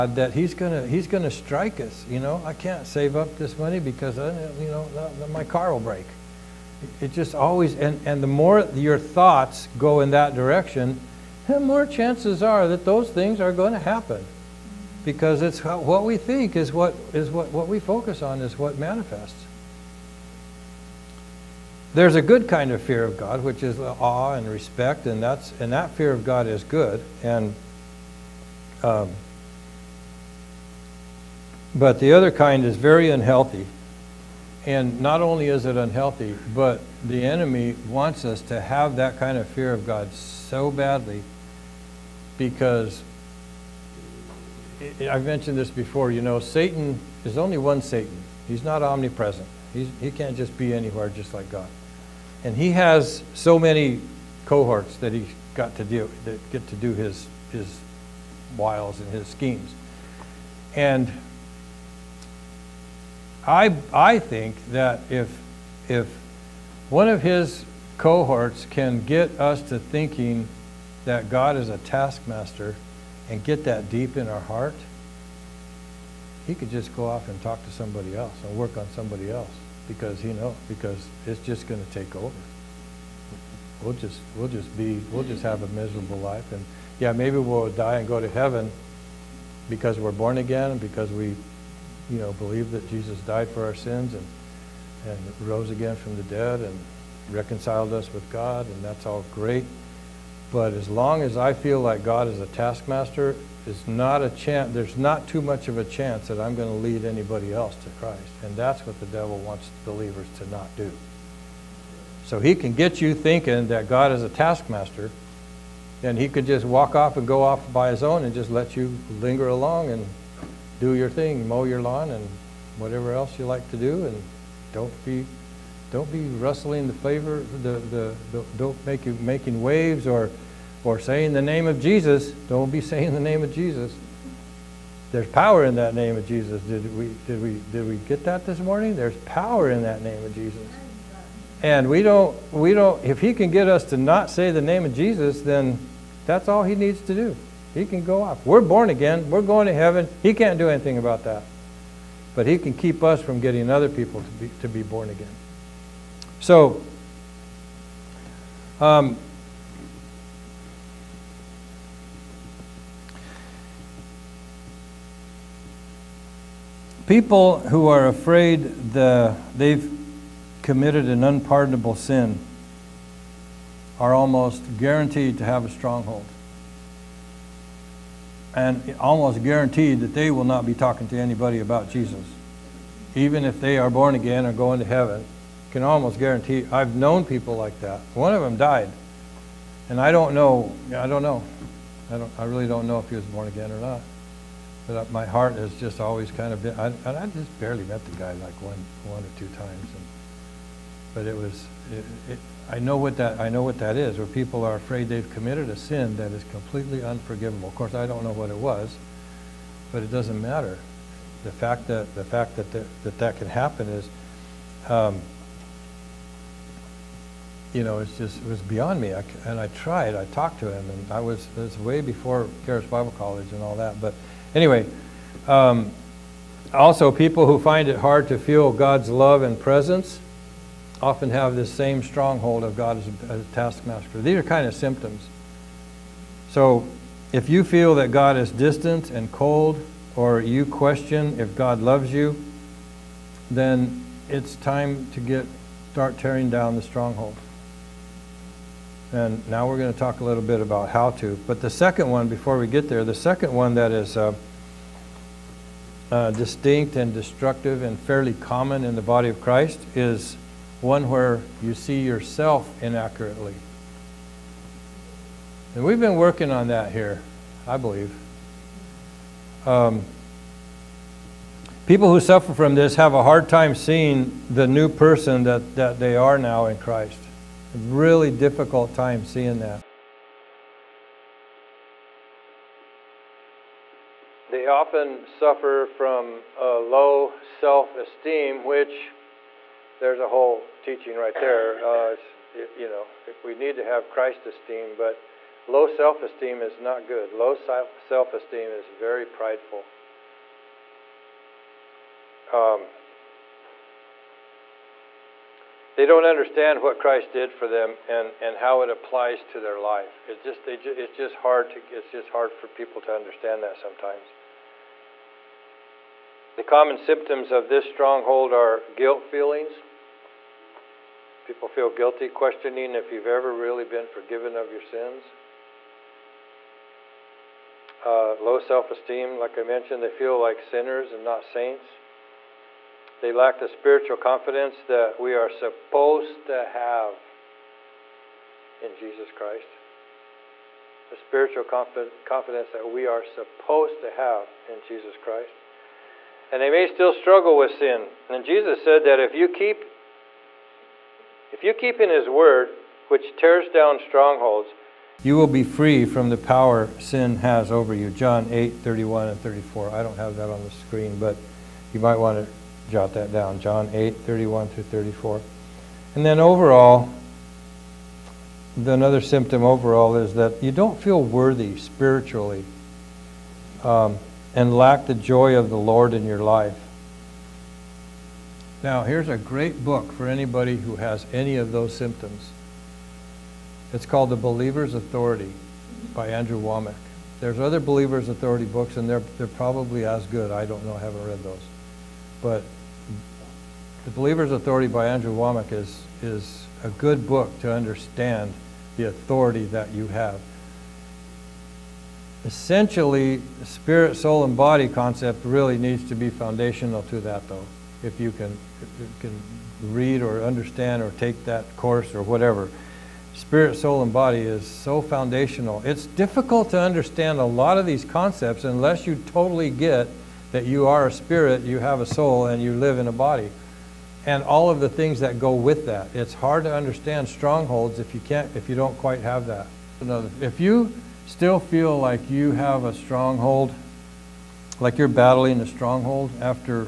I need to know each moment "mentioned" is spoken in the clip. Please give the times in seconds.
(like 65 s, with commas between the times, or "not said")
45 s, 329 s.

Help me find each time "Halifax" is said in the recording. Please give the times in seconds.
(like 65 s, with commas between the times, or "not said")
not said.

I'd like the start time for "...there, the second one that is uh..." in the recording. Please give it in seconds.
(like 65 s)
252 s.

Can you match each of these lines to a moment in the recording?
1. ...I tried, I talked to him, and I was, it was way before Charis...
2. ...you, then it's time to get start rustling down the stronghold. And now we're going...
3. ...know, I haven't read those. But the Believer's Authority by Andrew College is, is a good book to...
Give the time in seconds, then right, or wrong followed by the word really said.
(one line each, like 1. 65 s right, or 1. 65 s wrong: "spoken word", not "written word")
1. 219 s right
2. 242 s wrong: "tearing", not "rustling"
3. 390 s wrong: "Wommack", not "College".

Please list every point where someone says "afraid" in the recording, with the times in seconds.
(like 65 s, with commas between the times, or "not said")
168 s, 204 s.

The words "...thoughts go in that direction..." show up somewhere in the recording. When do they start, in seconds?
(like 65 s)
8 s.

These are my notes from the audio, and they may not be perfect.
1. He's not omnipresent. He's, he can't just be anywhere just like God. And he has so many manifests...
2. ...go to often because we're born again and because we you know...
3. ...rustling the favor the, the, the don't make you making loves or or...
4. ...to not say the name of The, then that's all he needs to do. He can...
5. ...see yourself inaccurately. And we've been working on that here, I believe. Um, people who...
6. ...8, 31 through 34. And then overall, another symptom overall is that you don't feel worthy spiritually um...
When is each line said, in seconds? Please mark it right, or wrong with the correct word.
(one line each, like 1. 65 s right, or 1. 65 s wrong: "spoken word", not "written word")
1. 48 s wrong: "cohorts", not "manifests"
2. 88 s wrong: "heaven", not "often"
3. 126 s wrong: "waves", not "loves"
4. 143 s wrong: "Jesus", not "The"
5. 261 s right
6. 363 s right.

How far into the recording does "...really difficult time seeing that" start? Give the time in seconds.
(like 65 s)
277 s.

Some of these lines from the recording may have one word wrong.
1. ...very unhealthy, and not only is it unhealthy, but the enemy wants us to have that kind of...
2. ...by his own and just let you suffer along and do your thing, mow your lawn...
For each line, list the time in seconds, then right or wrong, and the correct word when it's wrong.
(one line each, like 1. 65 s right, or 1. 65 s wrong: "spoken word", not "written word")
1. 32 s right
2. 117 s wrong: "linger", not "suffer".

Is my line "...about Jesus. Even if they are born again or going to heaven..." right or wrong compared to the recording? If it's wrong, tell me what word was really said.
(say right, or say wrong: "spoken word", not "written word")
right.